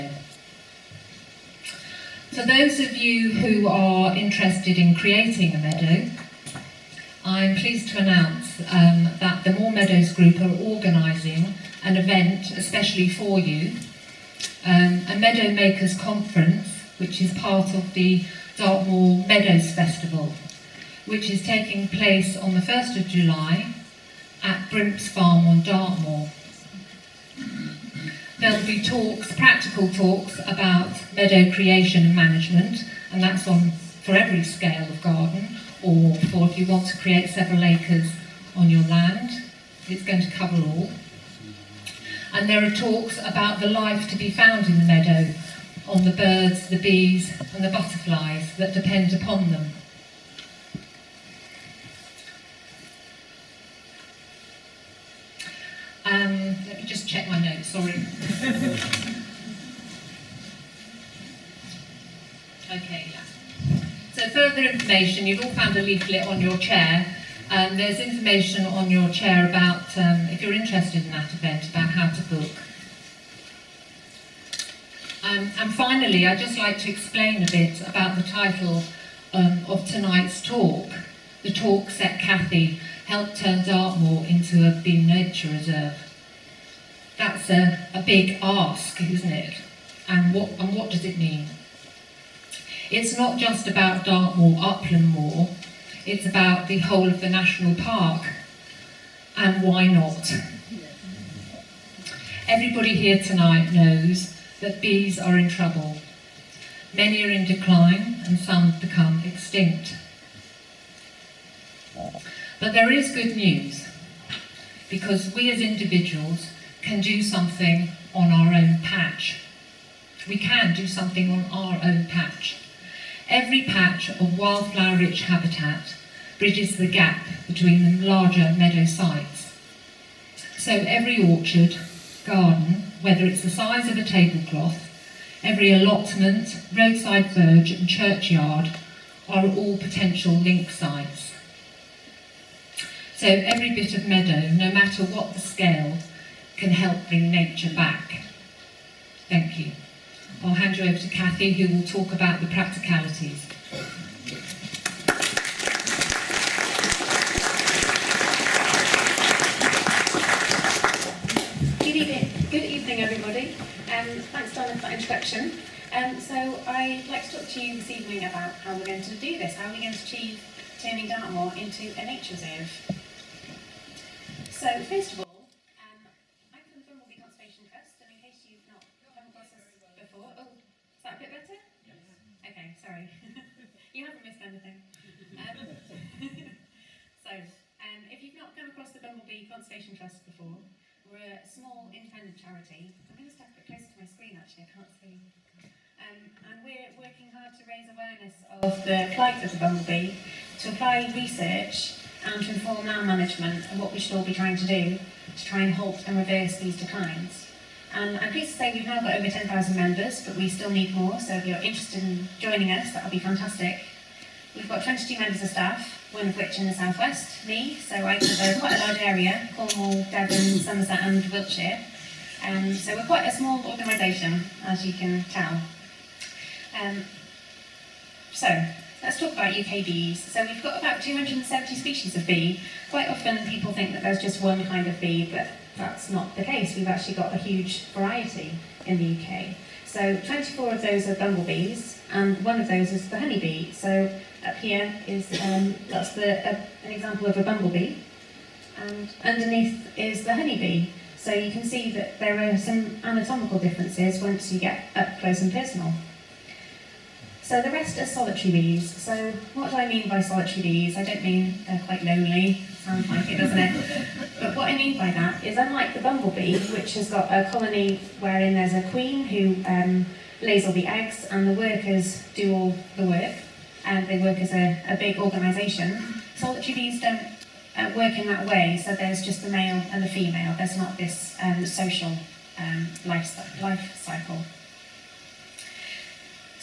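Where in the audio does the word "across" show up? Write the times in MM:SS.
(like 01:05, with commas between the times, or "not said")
02:59, 03:08.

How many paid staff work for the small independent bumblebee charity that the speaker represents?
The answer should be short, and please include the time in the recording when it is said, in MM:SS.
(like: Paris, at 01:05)
22, at 03:34.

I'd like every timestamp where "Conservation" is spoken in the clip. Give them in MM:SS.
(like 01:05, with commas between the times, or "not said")
02:57, 03:09.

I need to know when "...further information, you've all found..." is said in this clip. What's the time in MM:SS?
01:04.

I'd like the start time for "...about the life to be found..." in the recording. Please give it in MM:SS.
00:43.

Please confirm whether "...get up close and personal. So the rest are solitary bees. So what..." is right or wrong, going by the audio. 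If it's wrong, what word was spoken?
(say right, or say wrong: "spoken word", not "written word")
right.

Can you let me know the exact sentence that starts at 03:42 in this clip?
Um, so we're quite a small organisation, as you can tell.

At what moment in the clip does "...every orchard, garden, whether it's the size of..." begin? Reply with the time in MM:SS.
02:10.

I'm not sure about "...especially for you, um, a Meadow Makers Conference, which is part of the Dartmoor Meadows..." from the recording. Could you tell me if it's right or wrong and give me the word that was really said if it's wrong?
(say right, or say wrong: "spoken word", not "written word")
right.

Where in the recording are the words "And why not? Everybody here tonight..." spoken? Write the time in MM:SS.
01:39.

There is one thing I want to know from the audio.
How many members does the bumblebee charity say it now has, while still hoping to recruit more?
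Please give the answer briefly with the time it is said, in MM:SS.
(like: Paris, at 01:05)
10,000, at 03:29.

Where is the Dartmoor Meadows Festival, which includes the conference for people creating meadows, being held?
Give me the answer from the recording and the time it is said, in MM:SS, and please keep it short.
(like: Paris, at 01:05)
Brimpts Farm, at 00:24.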